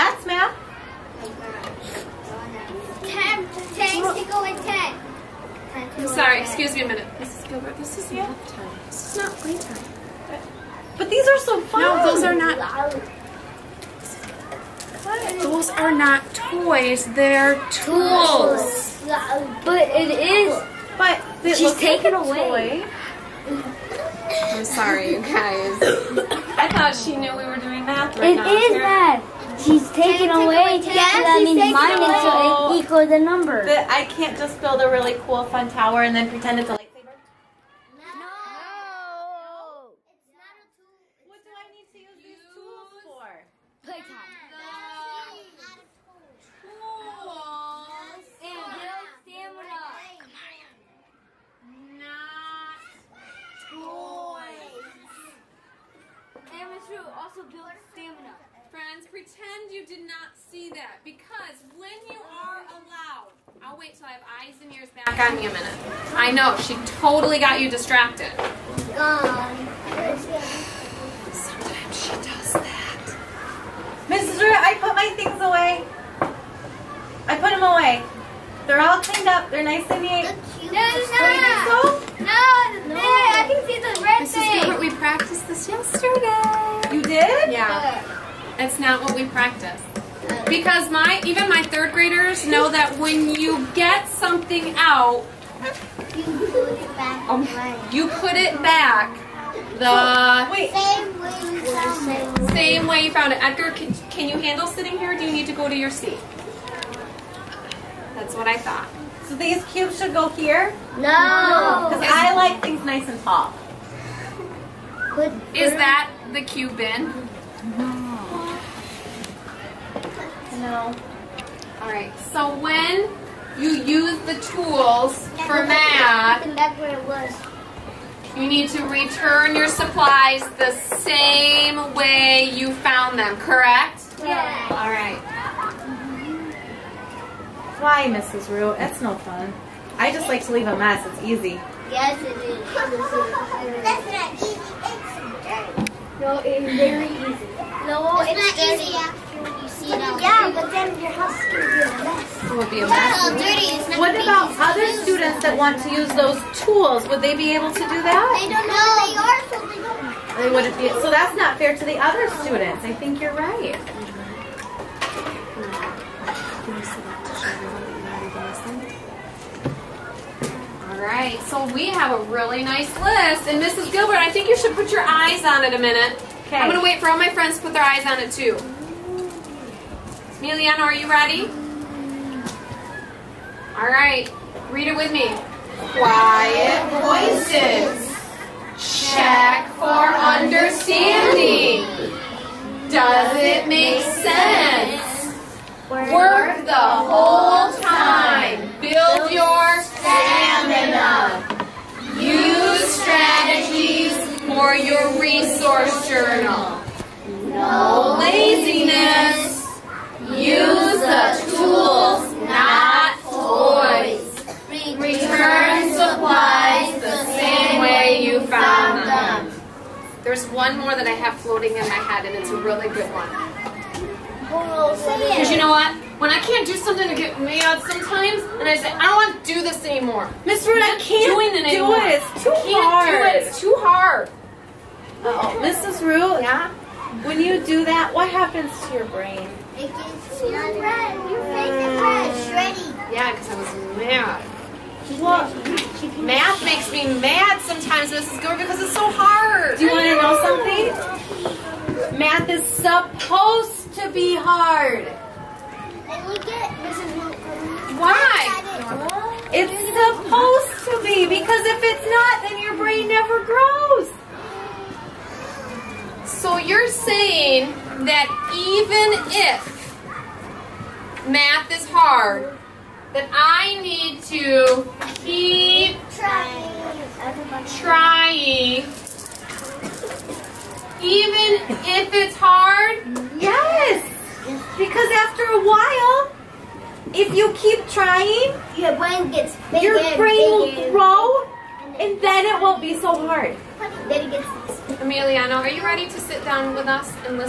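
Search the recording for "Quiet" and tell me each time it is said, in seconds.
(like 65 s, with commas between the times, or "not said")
185 s.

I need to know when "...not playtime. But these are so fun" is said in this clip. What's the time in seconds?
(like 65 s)
9 s.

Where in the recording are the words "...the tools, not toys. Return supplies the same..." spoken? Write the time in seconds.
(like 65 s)
210 s.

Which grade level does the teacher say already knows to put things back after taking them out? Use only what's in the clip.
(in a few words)
third graders.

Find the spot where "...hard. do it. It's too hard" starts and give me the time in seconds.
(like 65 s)
232 s.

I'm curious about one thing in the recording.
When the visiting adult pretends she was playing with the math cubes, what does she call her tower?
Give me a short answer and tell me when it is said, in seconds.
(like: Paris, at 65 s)
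lightsaber, at 36 s.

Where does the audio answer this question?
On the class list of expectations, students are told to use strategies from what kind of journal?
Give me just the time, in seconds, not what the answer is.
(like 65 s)
205 s.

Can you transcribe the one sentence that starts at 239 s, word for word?
It gets yeah, because I was mad.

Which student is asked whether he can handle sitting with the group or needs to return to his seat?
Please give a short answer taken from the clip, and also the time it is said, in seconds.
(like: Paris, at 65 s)
Edgar, at 103 s.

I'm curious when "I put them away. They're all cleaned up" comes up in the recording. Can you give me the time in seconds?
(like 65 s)
77 s.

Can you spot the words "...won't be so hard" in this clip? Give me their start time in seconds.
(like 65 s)
292 s.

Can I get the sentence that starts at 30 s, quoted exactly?
Yes, that means minus so equal the number.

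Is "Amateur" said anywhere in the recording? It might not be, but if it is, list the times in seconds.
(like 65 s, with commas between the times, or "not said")
56 s.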